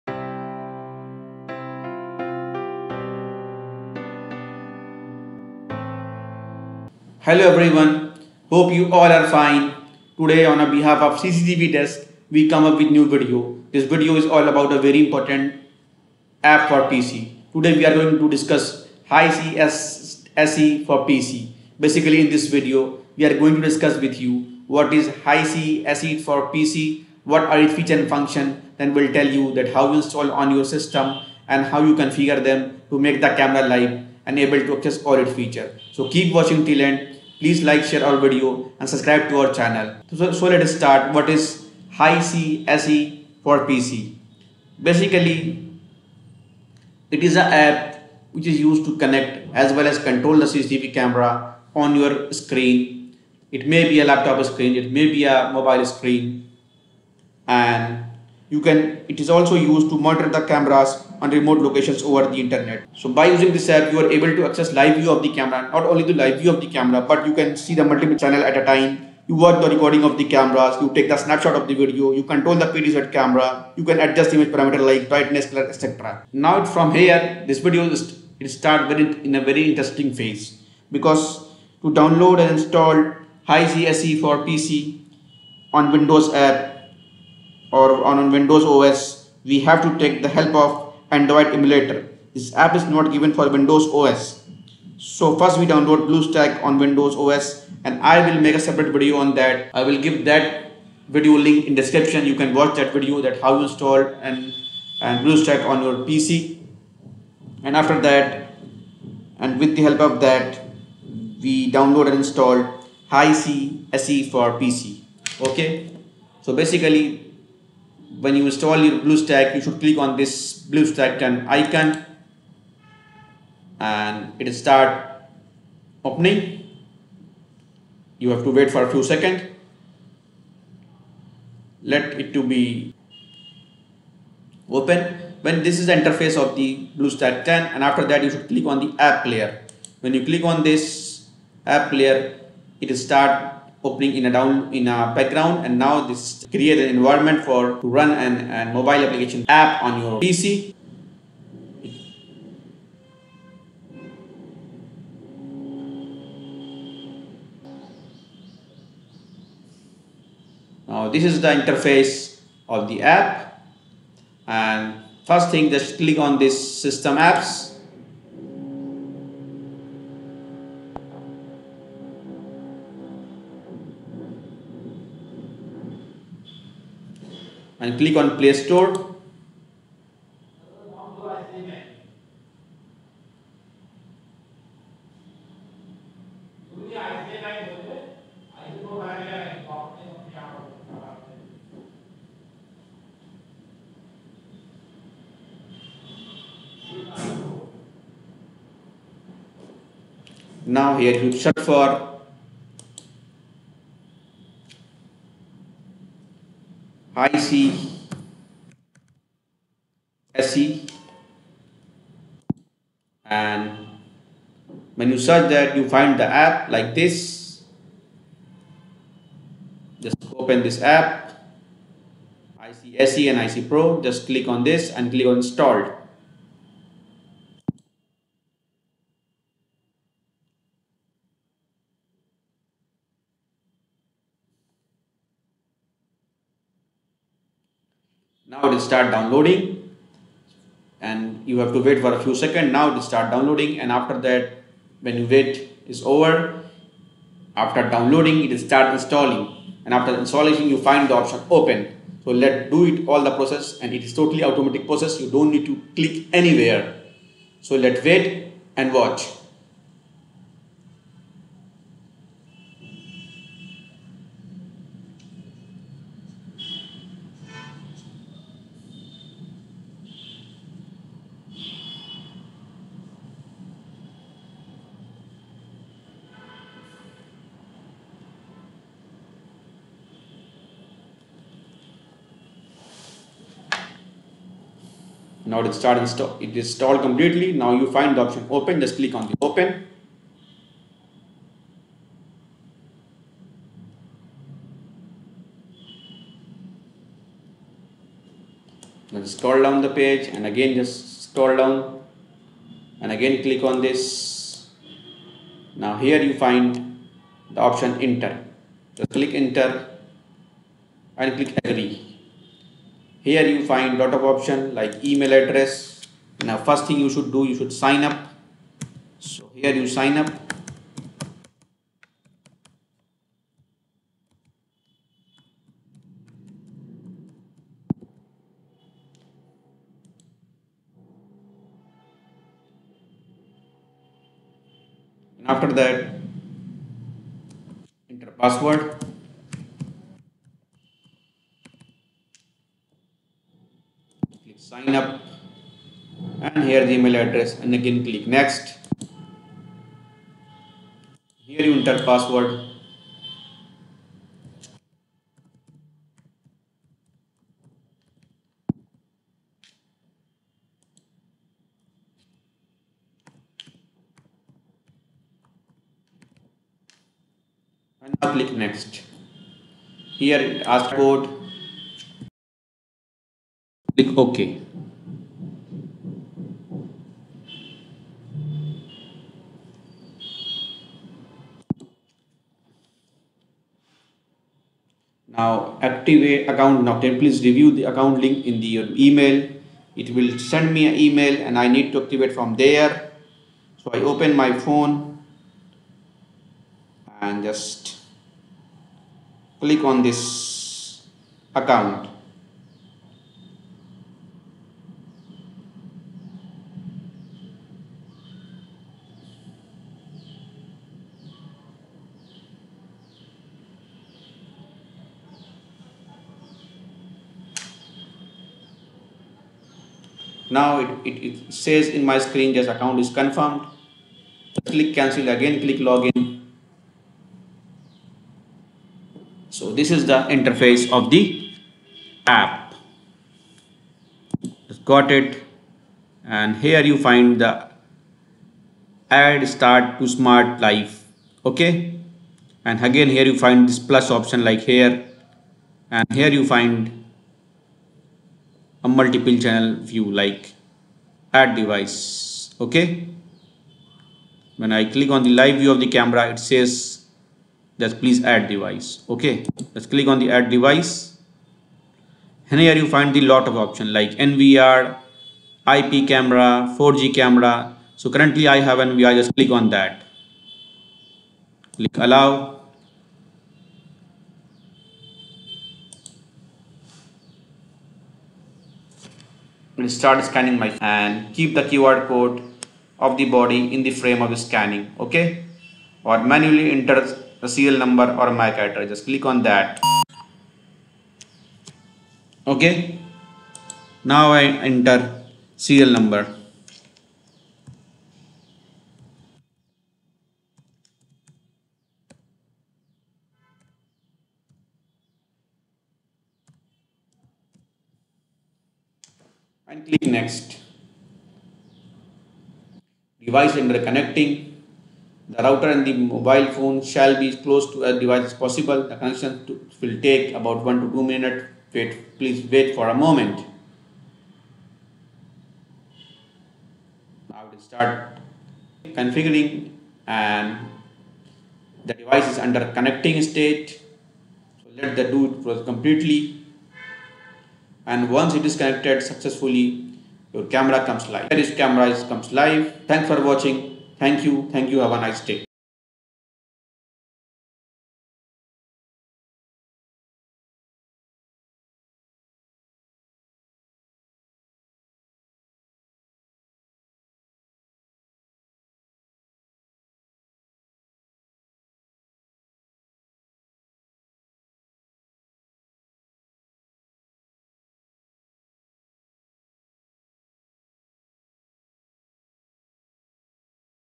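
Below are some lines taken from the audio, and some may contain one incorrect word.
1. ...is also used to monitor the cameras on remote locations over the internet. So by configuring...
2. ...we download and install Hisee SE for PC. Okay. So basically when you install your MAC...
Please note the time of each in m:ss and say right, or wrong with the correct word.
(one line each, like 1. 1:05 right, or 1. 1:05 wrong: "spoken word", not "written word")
1. 0:59 wrong: "using", not "configuring"
2. 1:51 wrong: "BlueStack", not "MAC".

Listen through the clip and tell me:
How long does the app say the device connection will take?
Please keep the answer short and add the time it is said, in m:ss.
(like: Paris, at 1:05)
1 to 2 minutes, at 8:40.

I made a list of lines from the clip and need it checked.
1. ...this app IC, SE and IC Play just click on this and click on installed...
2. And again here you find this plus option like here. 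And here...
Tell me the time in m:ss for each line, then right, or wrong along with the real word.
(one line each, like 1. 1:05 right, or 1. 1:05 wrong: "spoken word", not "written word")
1. 3:40 wrong: "Pro", not "Play"
2. 7:22 right.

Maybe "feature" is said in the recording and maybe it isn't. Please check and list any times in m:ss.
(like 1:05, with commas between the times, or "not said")
0:27, 0:35.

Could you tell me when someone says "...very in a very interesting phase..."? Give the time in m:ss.
1:18.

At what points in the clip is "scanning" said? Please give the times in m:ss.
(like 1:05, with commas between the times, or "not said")
8:00, 8:04.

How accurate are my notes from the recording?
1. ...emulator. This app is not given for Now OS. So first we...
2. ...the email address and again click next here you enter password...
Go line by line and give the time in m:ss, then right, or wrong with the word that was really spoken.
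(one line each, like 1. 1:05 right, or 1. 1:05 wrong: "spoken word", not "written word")
1. 1:31 wrong: "Windows", not "Now"
2. 5:46 right.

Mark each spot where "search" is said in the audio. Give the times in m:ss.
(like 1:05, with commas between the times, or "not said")
3:21, 3:35.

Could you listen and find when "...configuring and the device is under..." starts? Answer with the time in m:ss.
8:48.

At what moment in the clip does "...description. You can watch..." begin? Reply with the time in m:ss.
1:41.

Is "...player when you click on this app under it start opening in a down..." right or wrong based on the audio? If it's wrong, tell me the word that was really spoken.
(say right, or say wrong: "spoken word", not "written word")
wrong: "player", not "under".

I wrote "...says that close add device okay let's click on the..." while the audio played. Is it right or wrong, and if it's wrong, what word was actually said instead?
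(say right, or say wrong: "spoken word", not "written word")
wrong: "please", not "close".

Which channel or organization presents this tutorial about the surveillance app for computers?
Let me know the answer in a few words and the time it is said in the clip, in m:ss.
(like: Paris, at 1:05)
CCTV Desk, at 0:11.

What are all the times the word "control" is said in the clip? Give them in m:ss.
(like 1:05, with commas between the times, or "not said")
0:49, 1:12.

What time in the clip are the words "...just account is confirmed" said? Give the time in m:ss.
7:02.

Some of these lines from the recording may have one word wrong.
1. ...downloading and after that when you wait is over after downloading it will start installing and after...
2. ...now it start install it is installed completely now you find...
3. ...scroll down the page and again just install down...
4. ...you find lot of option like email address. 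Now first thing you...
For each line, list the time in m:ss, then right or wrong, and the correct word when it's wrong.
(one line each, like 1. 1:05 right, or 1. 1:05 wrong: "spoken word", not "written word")
1. 4:03 right
2. 4:45 right
3. 4:59 wrong: "scroll", not "install"
4. 5:13 right.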